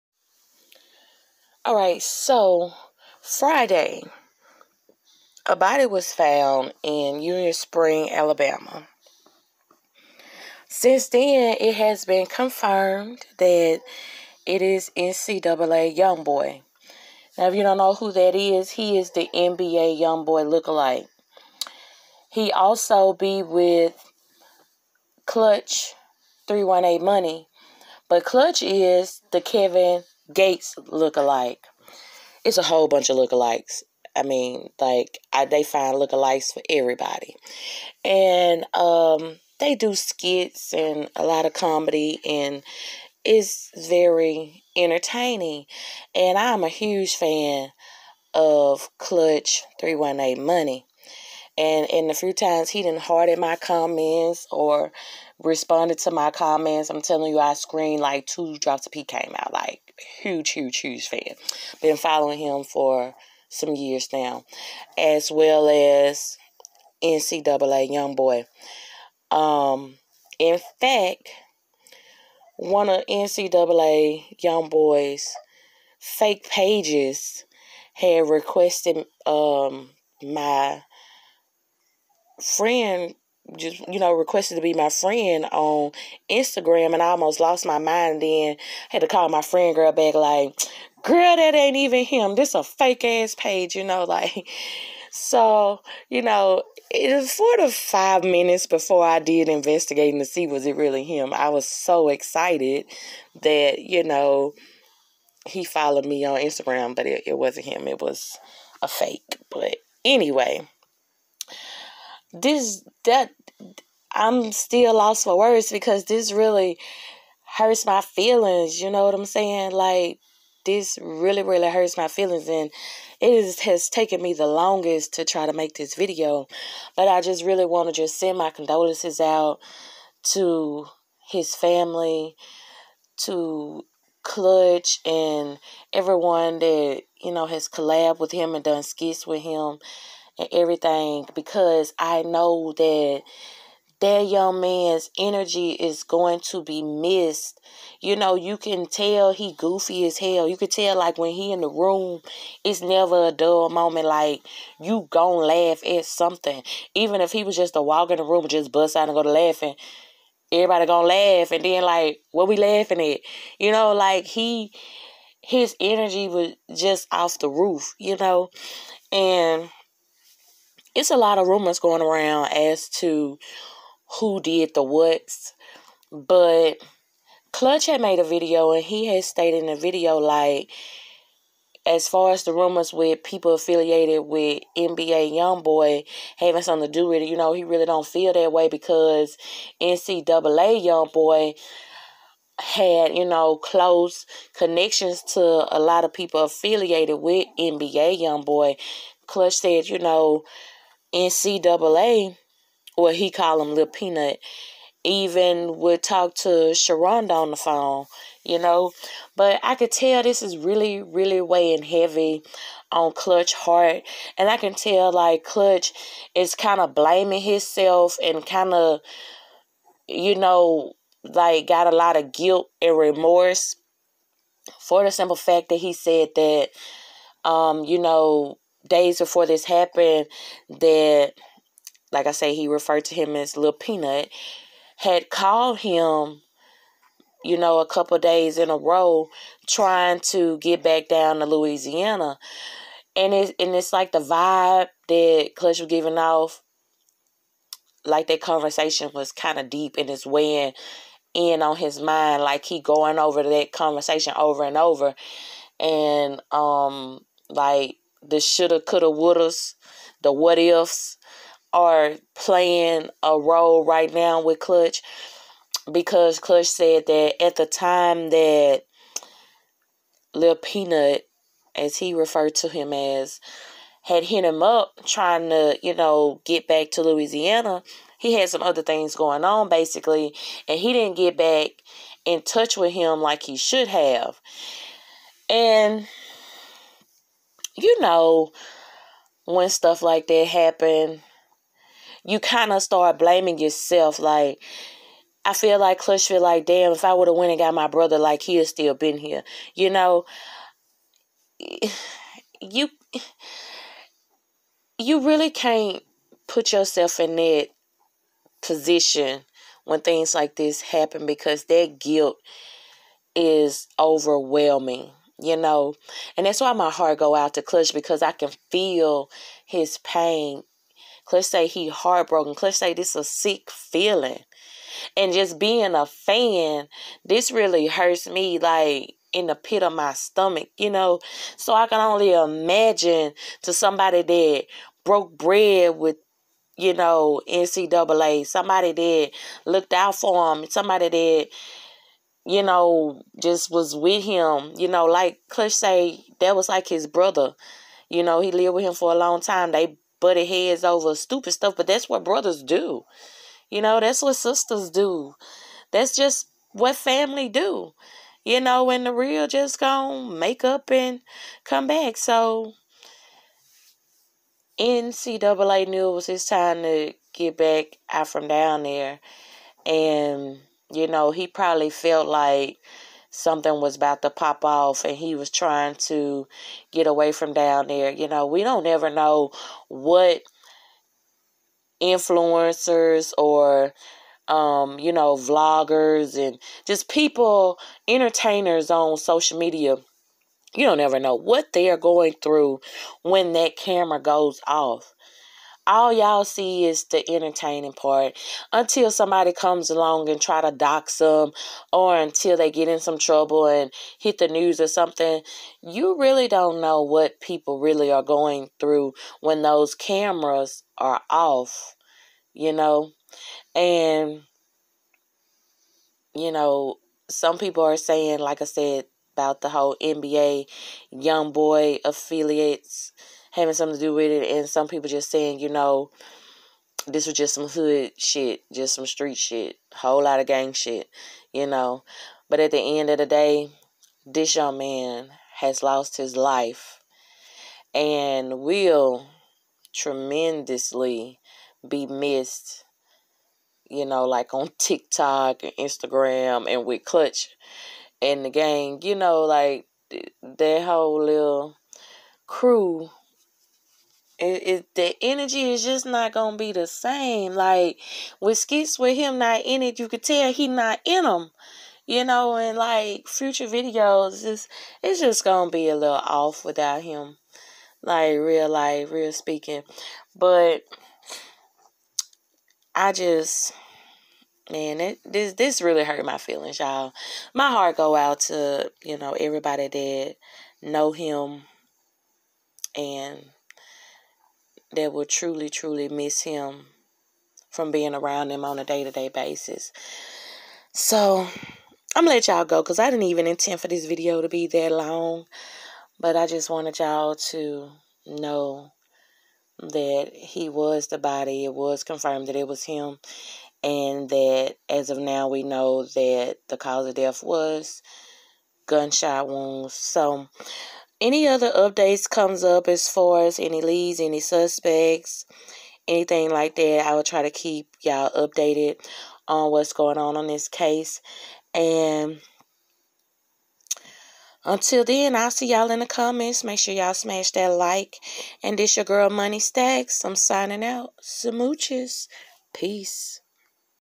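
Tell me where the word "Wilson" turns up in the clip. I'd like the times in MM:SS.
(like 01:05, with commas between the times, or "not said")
not said.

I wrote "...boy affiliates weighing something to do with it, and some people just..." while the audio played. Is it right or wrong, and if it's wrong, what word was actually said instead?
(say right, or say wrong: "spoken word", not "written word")
wrong: "having", not "weighing".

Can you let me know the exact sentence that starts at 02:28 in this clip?
You know, you can tell he goofy as hell.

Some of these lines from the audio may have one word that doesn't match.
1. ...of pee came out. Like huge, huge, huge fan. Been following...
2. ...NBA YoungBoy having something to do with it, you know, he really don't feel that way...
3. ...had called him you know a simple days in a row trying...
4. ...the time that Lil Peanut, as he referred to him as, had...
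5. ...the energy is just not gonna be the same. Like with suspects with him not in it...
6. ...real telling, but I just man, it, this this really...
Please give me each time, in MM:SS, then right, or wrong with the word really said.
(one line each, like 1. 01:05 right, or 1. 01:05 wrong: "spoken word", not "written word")
1. 00:58 right
2. 03:04 right
3. 03:54 wrong: "couple", not "simple"
4. 04:27 right
5. 07:34 wrong: "skits", not "suspects"
6. 07:49 wrong: "speaking", not "telling".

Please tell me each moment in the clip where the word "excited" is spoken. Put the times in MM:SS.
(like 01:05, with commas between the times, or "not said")
01:42.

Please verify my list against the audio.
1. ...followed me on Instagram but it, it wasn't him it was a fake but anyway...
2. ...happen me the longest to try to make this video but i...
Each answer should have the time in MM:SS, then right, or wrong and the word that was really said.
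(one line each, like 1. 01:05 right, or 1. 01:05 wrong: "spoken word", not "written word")
1. 01:45 right
2. 02:03 wrong: "taken", not "happen".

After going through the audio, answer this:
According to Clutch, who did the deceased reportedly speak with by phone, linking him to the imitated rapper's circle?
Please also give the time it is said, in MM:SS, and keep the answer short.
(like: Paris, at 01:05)
Sharonda, at 03:26.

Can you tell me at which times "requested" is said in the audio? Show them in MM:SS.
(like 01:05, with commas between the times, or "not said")
01:18, 01:24.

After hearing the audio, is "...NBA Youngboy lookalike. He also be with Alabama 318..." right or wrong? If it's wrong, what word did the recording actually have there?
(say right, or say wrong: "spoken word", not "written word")
wrong: "Clutch", not "Alabama".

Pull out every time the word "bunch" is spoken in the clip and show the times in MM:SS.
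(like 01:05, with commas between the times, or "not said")
00:32.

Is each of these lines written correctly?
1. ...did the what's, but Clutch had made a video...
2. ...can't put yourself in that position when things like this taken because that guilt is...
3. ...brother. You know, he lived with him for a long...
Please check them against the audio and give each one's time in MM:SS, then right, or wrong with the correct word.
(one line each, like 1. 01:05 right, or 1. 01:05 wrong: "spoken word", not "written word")
1. 02:54 right
2. 05:05 wrong: "happen", not "taken"
3. 05:47 right.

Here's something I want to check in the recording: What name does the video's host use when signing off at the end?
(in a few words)
Moni Stackz.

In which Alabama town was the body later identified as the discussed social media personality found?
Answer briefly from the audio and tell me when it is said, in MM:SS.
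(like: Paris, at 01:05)
Union Spring, at 00:07.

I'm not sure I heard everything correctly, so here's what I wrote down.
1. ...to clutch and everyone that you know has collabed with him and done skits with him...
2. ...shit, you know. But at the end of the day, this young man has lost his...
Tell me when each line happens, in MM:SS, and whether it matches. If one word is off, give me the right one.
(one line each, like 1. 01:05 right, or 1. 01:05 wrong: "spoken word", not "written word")
1. 02:13 right
2. 07:10 right.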